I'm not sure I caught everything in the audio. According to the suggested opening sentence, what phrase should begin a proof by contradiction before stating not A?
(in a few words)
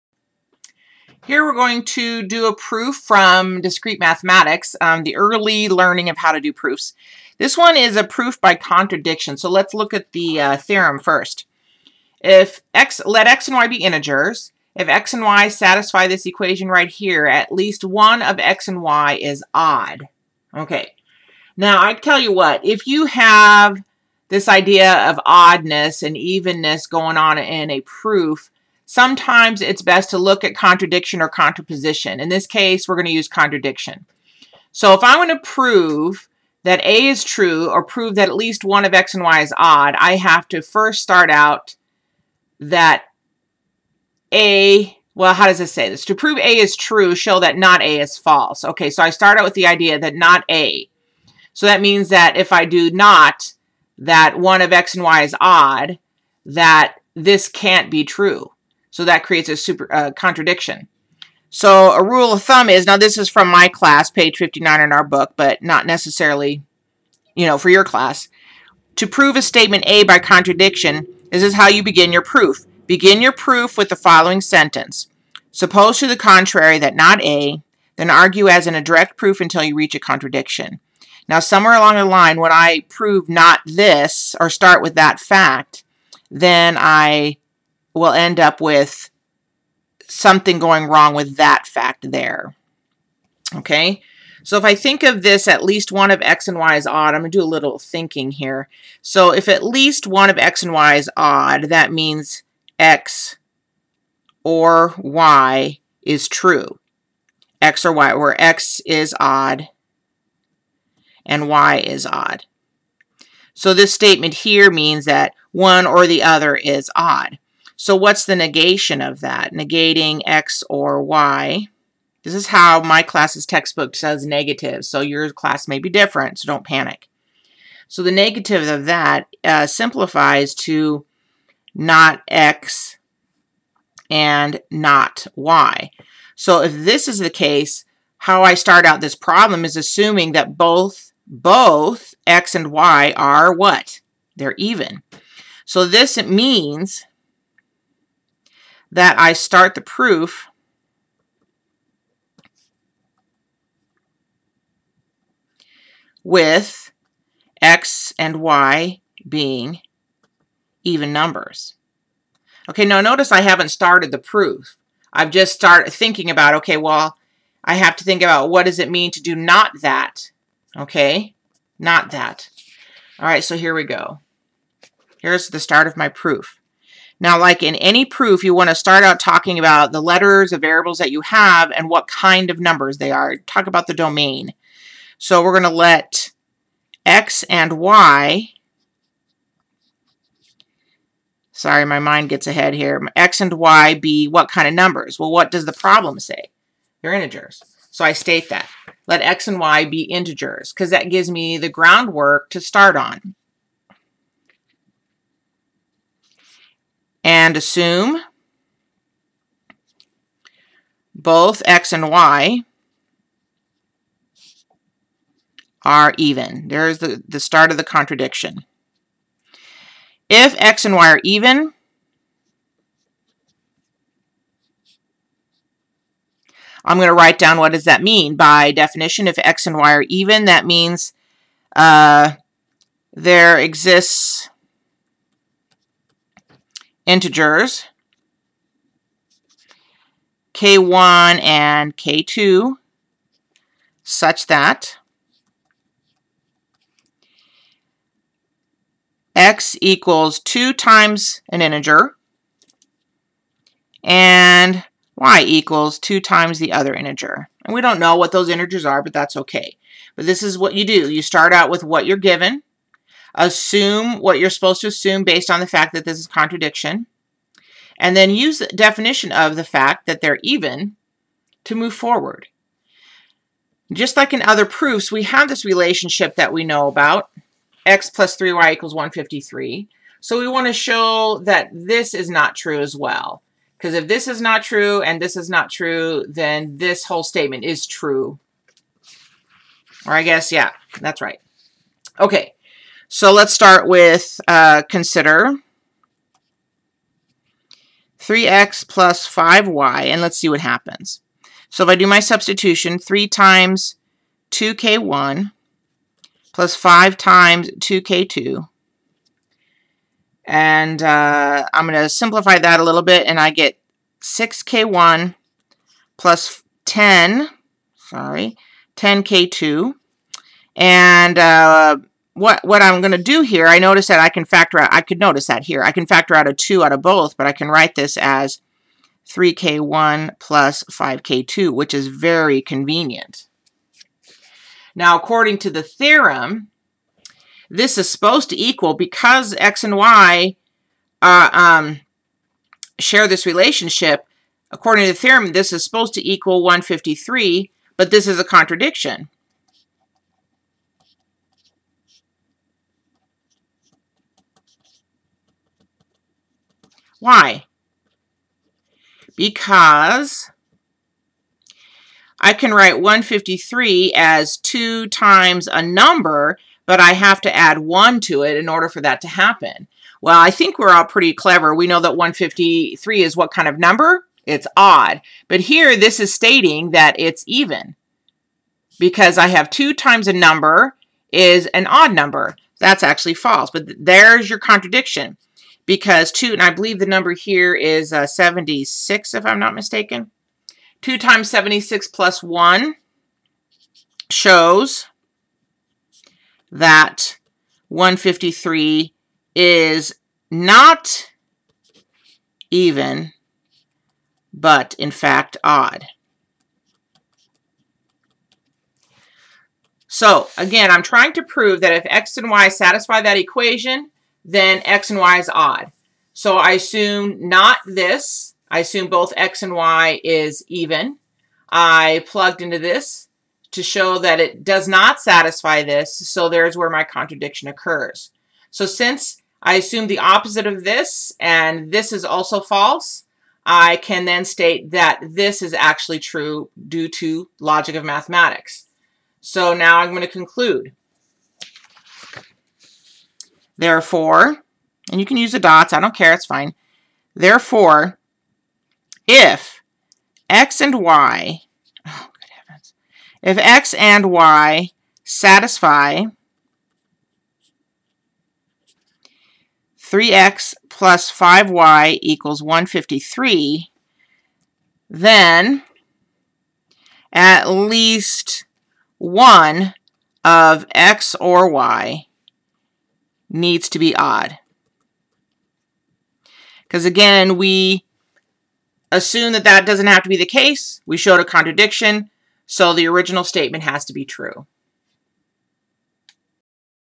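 Suppose to the contrary.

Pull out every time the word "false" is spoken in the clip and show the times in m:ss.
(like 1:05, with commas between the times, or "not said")
0:48, 6:23, 7:12.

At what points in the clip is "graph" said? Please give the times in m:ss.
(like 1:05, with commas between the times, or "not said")
not said.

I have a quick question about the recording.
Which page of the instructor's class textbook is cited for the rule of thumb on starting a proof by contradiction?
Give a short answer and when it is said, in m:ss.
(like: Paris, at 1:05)
59, at 1:04.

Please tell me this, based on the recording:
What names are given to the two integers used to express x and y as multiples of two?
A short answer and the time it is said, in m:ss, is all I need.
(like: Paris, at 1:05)
k1 and k2, at 4:00.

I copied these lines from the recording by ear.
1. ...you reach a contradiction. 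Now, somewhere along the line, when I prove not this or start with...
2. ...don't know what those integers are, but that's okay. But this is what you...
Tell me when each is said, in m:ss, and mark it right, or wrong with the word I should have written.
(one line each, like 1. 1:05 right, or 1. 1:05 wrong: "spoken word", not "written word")
1. 1:19 right
2. 4:17 right.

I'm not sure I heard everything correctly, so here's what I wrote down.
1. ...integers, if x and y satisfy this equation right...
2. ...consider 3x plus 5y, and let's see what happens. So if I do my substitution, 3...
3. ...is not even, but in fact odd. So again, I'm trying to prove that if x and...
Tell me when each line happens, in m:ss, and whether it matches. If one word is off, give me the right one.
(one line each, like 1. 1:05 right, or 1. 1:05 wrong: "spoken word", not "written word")
1. 0:13 right
2. 4:54 right
3. 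6:39 right.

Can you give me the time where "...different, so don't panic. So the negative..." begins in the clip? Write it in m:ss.
2:05.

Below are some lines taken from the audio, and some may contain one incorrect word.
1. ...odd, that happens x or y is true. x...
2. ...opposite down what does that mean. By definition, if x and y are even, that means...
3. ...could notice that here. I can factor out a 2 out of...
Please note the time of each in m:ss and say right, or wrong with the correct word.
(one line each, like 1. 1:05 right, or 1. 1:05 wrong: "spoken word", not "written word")
1. 1:41 wrong: "means", not "happens"
2. 3:47 wrong: "write", not "opposite"
3. 5:25 right.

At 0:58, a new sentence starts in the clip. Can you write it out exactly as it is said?
So that creates a super uh, contradiction.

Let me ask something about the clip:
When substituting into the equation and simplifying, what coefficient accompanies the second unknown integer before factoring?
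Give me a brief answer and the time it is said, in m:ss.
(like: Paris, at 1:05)
10, at 5:18.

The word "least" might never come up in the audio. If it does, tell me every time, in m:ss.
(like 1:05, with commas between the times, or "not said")
0:17, 0:38, 1:35, 1:39, 7:47.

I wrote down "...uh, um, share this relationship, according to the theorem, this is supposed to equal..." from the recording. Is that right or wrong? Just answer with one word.
right.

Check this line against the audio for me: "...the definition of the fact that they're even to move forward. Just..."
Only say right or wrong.
right.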